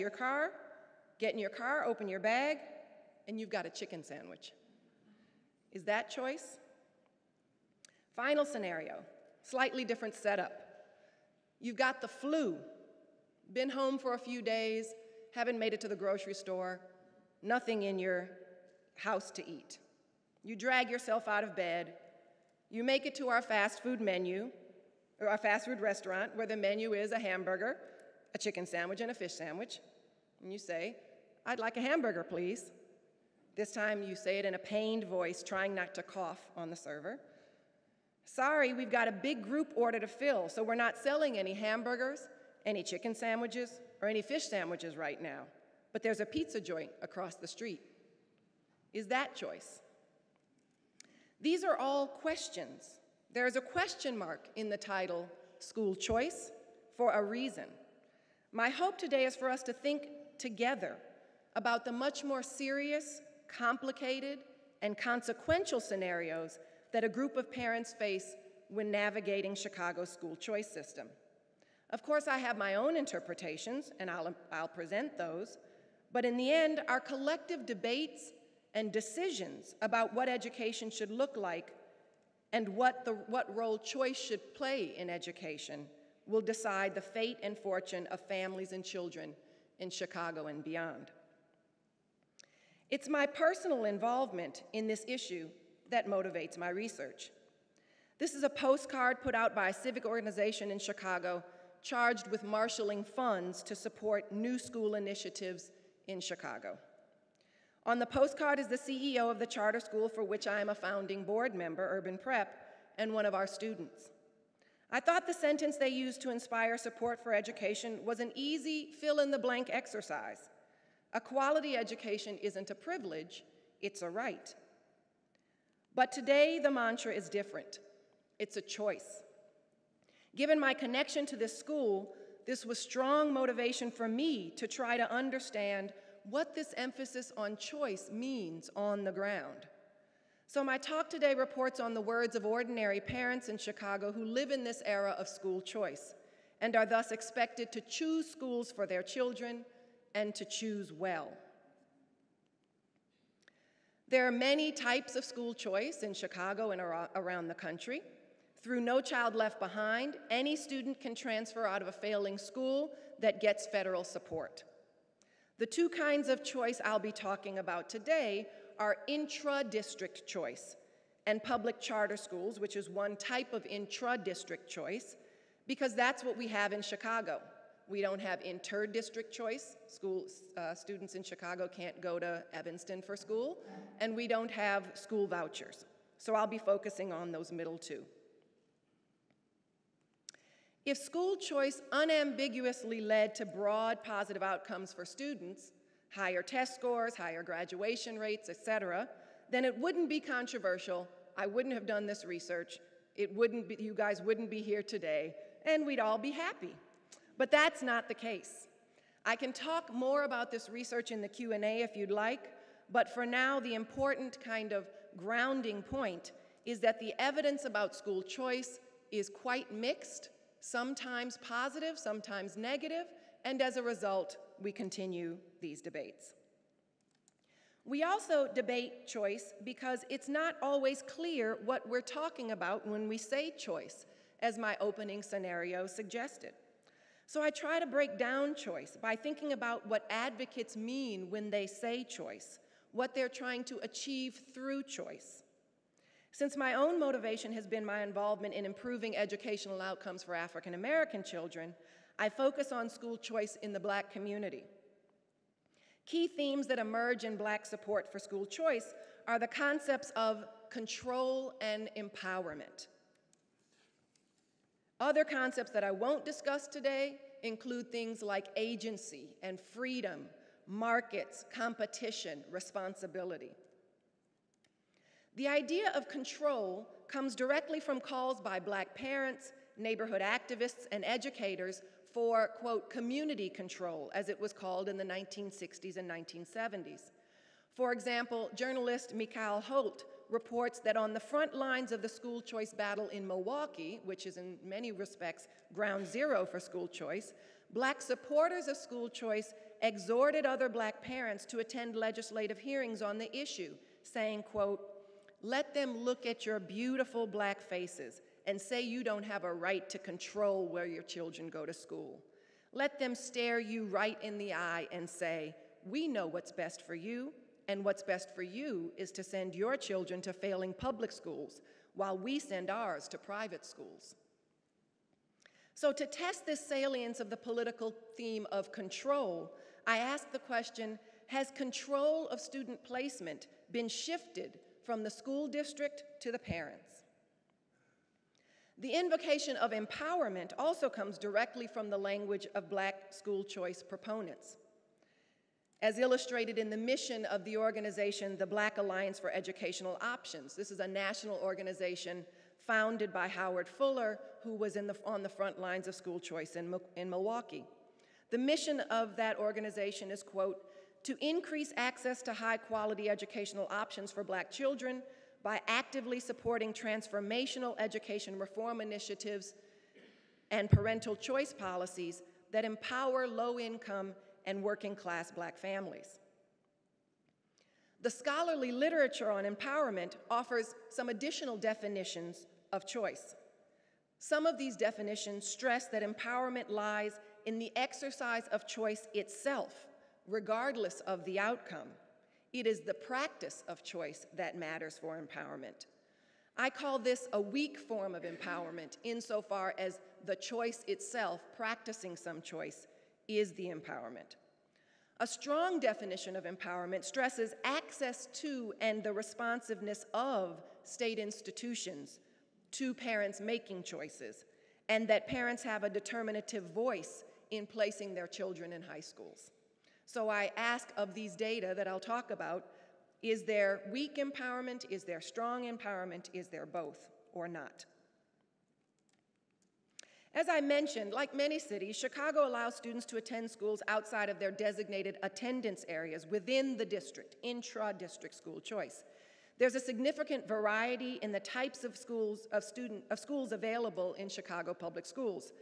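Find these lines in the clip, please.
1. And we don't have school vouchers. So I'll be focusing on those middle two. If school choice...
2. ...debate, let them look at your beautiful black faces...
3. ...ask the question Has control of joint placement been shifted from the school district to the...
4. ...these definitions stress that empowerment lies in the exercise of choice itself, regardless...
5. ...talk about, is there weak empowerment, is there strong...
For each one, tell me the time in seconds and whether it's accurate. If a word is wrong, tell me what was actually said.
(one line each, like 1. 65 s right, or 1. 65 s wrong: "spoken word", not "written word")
1. 183 s right
2. 304 s wrong: "quote", not "debate"
3. 329 s wrong: "student", not "joint"
4. 384 s right
5. 421 s right.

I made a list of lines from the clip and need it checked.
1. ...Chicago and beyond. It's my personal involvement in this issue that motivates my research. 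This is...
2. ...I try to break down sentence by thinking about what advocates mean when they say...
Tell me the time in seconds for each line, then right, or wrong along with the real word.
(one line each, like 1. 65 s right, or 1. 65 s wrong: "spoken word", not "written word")
1. 89 s right
2. 237 s wrong: "choice", not "sentence".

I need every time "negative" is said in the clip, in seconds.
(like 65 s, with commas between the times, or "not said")
222 s.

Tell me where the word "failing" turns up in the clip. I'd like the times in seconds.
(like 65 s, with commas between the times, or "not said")
161 s, 320 s.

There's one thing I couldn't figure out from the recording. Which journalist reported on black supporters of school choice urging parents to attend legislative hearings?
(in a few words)
Mikel Holt.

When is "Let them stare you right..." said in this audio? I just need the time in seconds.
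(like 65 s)
312 s.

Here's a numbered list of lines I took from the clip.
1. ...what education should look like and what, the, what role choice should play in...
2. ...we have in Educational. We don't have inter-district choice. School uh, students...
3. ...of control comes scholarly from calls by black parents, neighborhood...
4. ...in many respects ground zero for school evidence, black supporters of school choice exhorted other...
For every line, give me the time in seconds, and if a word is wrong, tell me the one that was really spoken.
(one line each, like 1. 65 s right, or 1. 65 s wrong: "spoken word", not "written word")
1. 80 s right
2. 176 s wrong: "Chicago", not "Educational"
3. 275 s wrong: "directly", not "scholarly"
4. 294 s wrong: "choice", not "evidence".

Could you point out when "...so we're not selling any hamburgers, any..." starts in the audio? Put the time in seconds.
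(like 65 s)
40 s.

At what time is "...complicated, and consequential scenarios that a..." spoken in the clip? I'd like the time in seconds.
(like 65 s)
63 s.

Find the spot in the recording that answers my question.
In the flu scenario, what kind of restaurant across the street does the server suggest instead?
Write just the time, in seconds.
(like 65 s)
46 s.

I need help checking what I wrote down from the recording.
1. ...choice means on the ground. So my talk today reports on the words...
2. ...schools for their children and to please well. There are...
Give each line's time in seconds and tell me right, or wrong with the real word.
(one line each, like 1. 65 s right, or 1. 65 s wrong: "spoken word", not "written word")
1. 137 s right
2. 148 s wrong: "choose", not "please".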